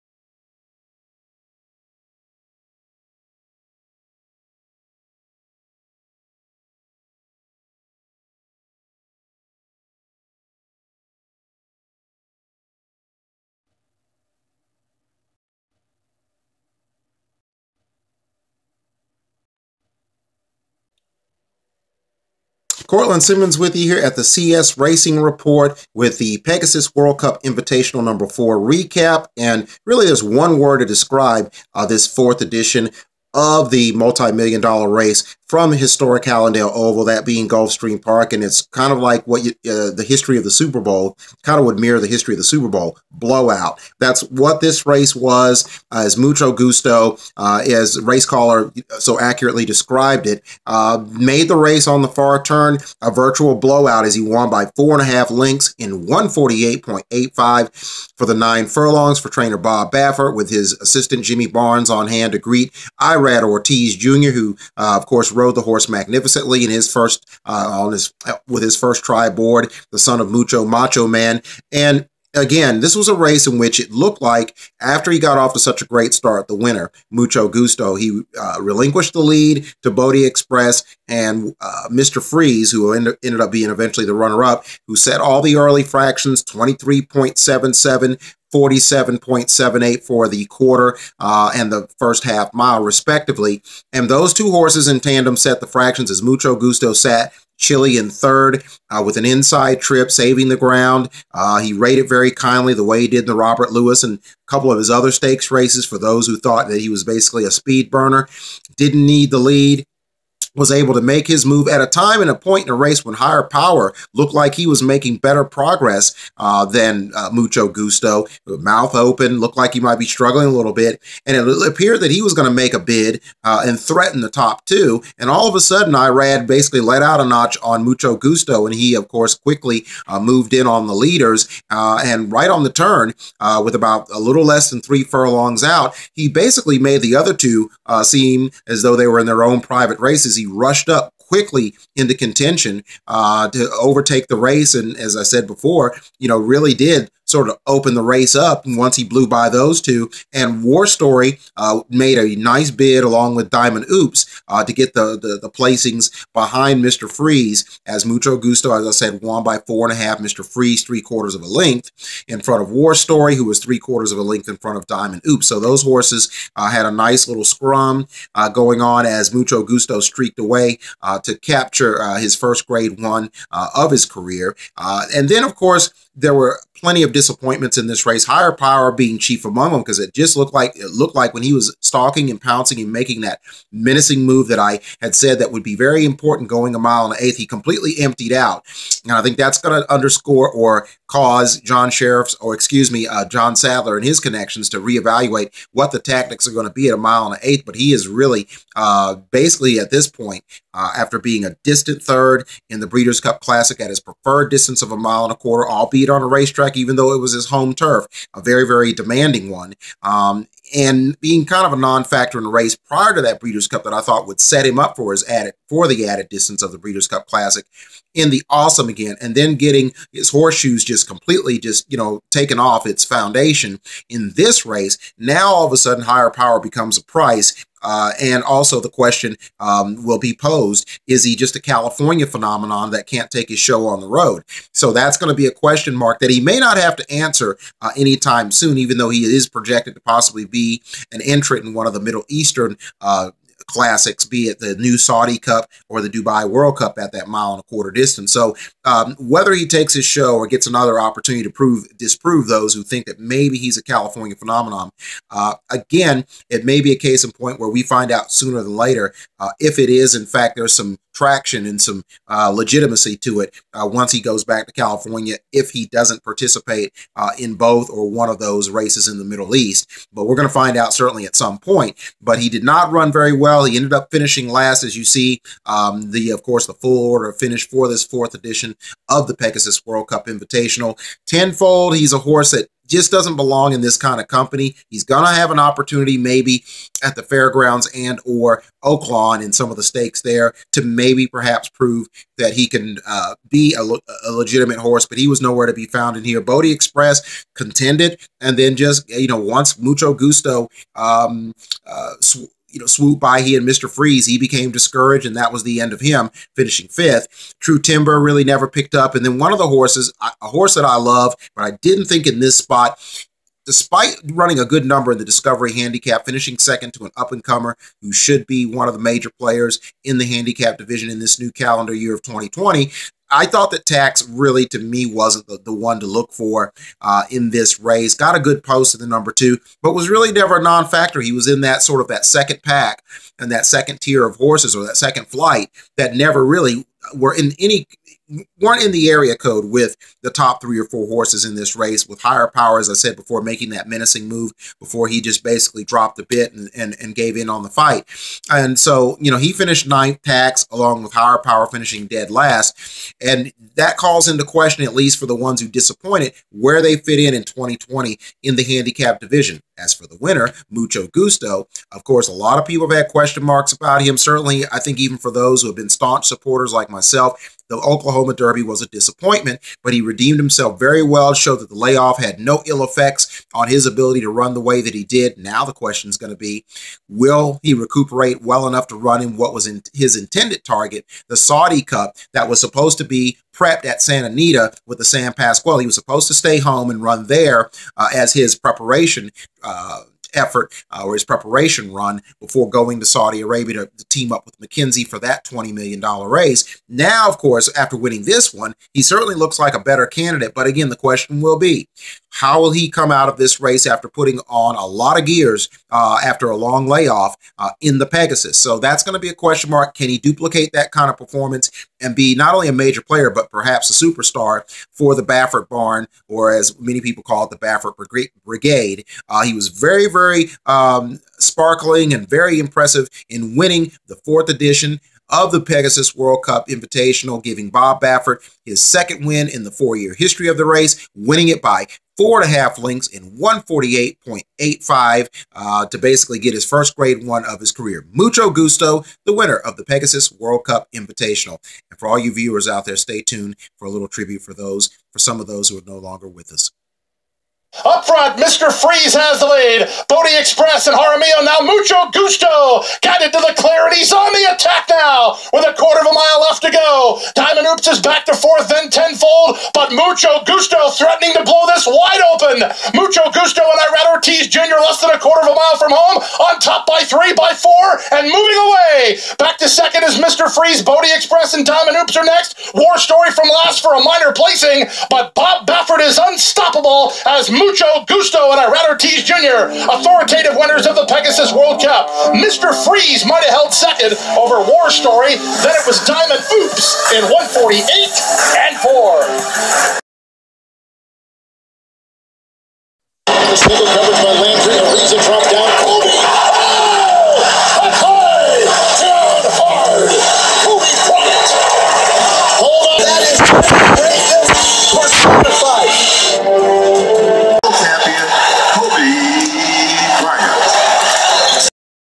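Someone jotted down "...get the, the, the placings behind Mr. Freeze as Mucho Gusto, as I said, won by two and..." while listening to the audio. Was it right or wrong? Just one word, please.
wrong.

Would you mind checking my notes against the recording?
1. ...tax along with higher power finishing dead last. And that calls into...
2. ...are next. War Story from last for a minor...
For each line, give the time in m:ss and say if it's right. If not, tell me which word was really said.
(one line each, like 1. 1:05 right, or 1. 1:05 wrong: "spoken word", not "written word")
1. 5:50 right
2. 7:52 right.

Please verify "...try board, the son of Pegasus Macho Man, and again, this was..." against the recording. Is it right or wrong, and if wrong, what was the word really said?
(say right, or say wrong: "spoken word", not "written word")
wrong: "Mucho", not "Pegasus".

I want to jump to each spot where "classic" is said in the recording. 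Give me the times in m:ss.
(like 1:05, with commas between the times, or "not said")
3:23, 3:37, 4:03.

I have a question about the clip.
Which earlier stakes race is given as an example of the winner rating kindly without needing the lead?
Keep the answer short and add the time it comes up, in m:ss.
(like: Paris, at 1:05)
Robert Lewis, at 1:43.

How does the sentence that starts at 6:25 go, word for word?
He was supposed to stay home and run there uh, as his preparation.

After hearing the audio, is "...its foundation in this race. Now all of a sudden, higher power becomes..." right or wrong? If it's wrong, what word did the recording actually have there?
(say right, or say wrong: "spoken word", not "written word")
right.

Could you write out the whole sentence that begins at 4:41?
Tenfold, he's a horse that just doesn't belong in this kind of company.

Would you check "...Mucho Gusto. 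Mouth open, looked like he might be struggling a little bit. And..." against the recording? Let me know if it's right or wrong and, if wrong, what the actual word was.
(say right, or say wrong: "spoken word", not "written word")
right.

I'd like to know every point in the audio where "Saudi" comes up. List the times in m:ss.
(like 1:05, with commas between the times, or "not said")
4:04, 6:21, 6:33.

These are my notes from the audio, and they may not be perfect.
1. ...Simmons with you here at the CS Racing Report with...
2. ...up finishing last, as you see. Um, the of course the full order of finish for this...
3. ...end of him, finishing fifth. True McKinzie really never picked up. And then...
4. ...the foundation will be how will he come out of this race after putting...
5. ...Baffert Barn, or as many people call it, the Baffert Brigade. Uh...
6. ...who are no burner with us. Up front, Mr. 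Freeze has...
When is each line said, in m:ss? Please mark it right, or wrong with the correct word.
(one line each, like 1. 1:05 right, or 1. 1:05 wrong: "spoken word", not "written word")
1. 0:23 right
2. 4:33 right
3. 5:05 wrong: "Timber", not "McKinzie"
4. 6:40 wrong: "question", not "foundation"
5. 6:55 right
6. 7:25 wrong: "longer", not "burner".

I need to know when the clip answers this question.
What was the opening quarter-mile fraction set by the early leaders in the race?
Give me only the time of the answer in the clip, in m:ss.
1:26.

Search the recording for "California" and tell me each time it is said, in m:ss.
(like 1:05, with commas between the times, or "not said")
3:51, 4:13, 4:24.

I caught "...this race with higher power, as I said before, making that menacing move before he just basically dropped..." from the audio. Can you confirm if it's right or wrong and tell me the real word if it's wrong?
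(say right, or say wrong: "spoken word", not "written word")
right.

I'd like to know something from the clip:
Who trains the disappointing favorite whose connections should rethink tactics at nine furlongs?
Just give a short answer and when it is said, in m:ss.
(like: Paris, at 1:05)
John Sadler, at 3:13.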